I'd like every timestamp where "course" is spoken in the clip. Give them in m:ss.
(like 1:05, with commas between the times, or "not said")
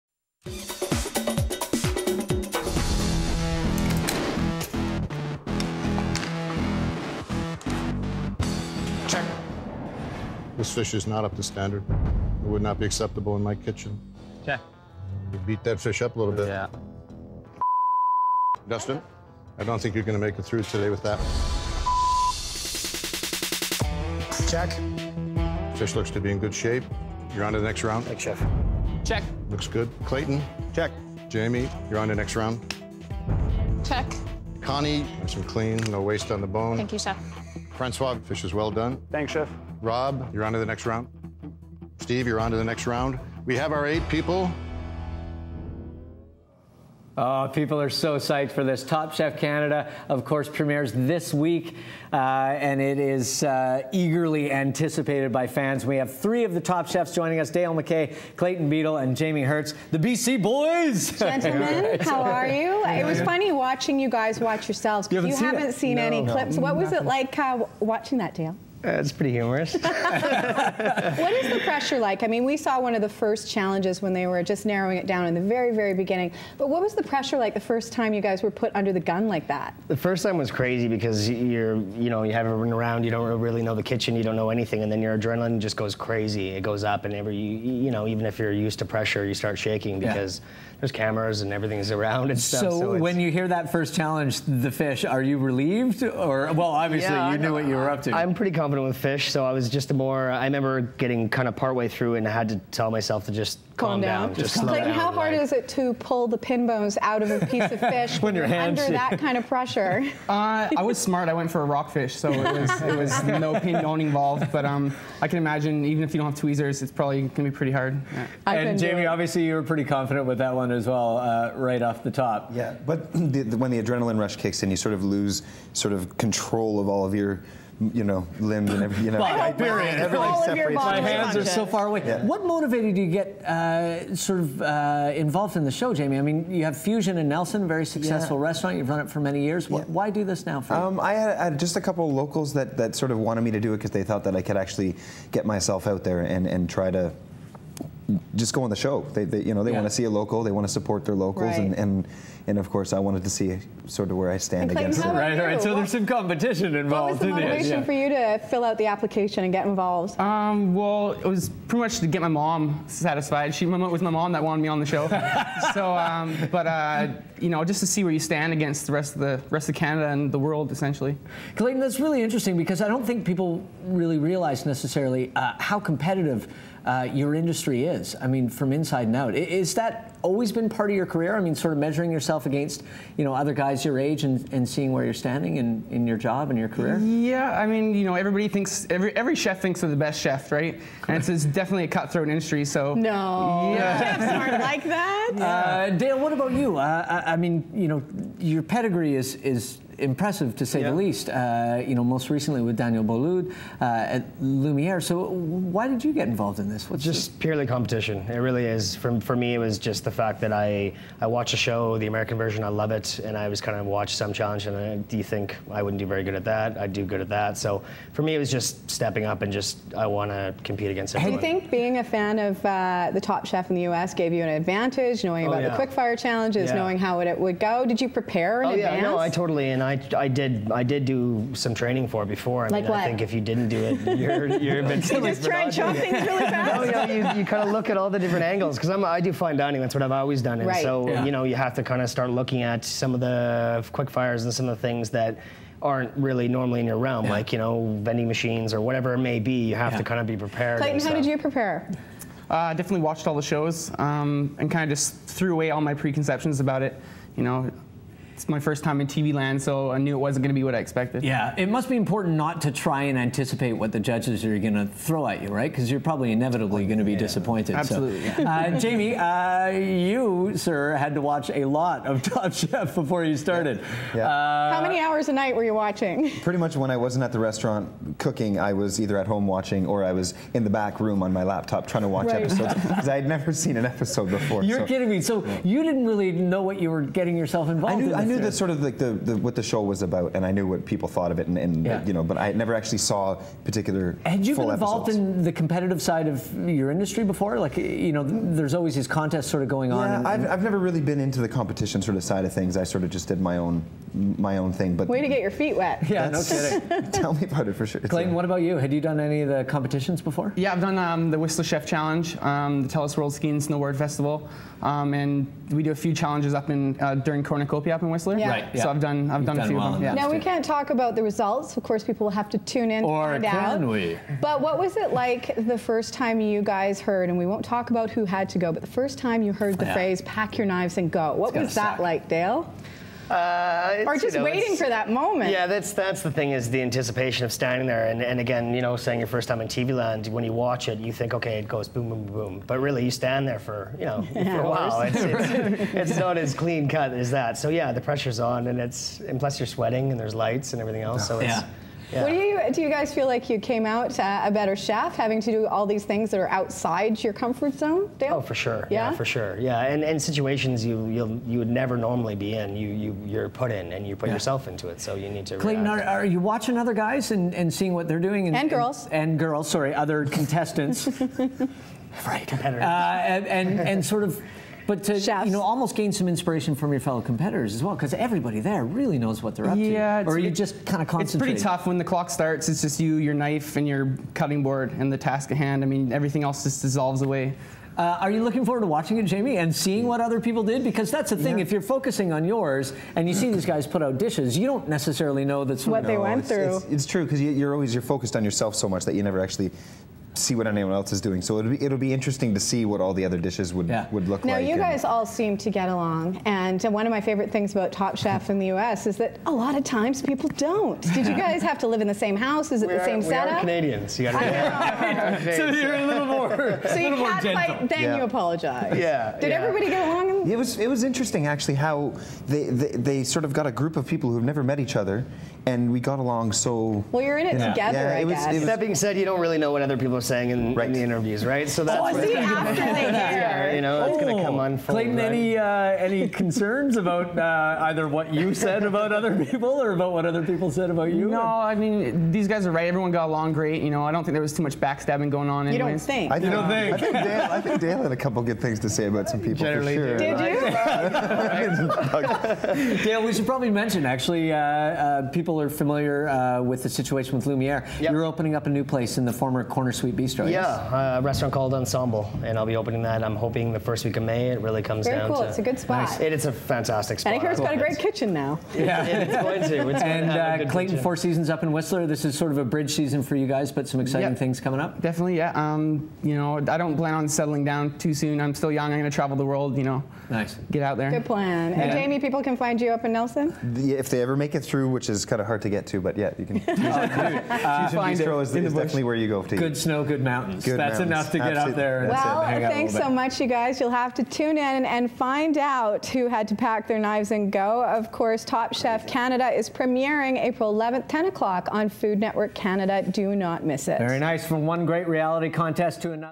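0:50, 2:32, 5:21, 8:18.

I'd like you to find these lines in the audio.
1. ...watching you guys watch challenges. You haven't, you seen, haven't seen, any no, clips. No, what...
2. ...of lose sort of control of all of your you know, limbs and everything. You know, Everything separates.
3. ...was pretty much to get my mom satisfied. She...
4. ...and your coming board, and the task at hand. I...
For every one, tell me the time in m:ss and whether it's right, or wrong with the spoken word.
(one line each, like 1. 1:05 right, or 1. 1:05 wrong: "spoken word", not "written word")
1. 1:03 wrong: "yourselves", not "challenges"
2. 2:04 right
3. 2:41 right
4. 6:23 wrong: "cutting", not "coming".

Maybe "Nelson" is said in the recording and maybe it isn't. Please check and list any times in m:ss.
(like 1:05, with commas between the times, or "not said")
2:17, 8:03.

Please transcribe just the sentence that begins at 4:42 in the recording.
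episodes because I had never seen an episode before.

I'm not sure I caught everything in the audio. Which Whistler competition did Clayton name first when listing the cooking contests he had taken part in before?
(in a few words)
Whistler Chef Challenge.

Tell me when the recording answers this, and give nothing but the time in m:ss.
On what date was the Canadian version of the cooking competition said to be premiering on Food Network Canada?
8:20.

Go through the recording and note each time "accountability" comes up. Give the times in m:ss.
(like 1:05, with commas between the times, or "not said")
not said.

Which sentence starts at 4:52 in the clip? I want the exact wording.
you know, but I never actually saw particular.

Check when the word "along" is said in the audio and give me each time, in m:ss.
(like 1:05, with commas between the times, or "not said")
6:45, 7:00, 7:06, 7:23.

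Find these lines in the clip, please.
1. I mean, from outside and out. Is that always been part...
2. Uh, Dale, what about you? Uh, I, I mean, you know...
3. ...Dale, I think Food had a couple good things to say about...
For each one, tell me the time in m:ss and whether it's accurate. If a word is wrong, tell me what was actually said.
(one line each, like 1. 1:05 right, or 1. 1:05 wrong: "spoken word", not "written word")
1. 2:58 wrong: "inside", not "outside"
2. 3:15 right
3. 7:27 wrong: "Dale", not "Food".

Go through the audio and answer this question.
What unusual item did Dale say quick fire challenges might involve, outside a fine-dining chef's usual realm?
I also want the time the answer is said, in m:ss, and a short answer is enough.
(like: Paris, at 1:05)
Vending machines, at 4:08.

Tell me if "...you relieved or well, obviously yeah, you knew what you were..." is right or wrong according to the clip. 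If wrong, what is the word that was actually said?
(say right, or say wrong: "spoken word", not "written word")
right.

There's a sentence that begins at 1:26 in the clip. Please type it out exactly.
It goes up, and every, you, you know, even if you're used to pressure, you start shaking because.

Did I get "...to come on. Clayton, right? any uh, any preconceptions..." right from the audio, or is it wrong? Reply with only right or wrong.
wrong.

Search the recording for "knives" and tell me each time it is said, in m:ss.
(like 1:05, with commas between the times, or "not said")
5:30, 8:16.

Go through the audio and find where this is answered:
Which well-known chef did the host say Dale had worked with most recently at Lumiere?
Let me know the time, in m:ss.
3:22.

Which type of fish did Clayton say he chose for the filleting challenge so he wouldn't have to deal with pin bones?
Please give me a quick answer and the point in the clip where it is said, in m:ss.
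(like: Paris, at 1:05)
Rockfish, at 1:51.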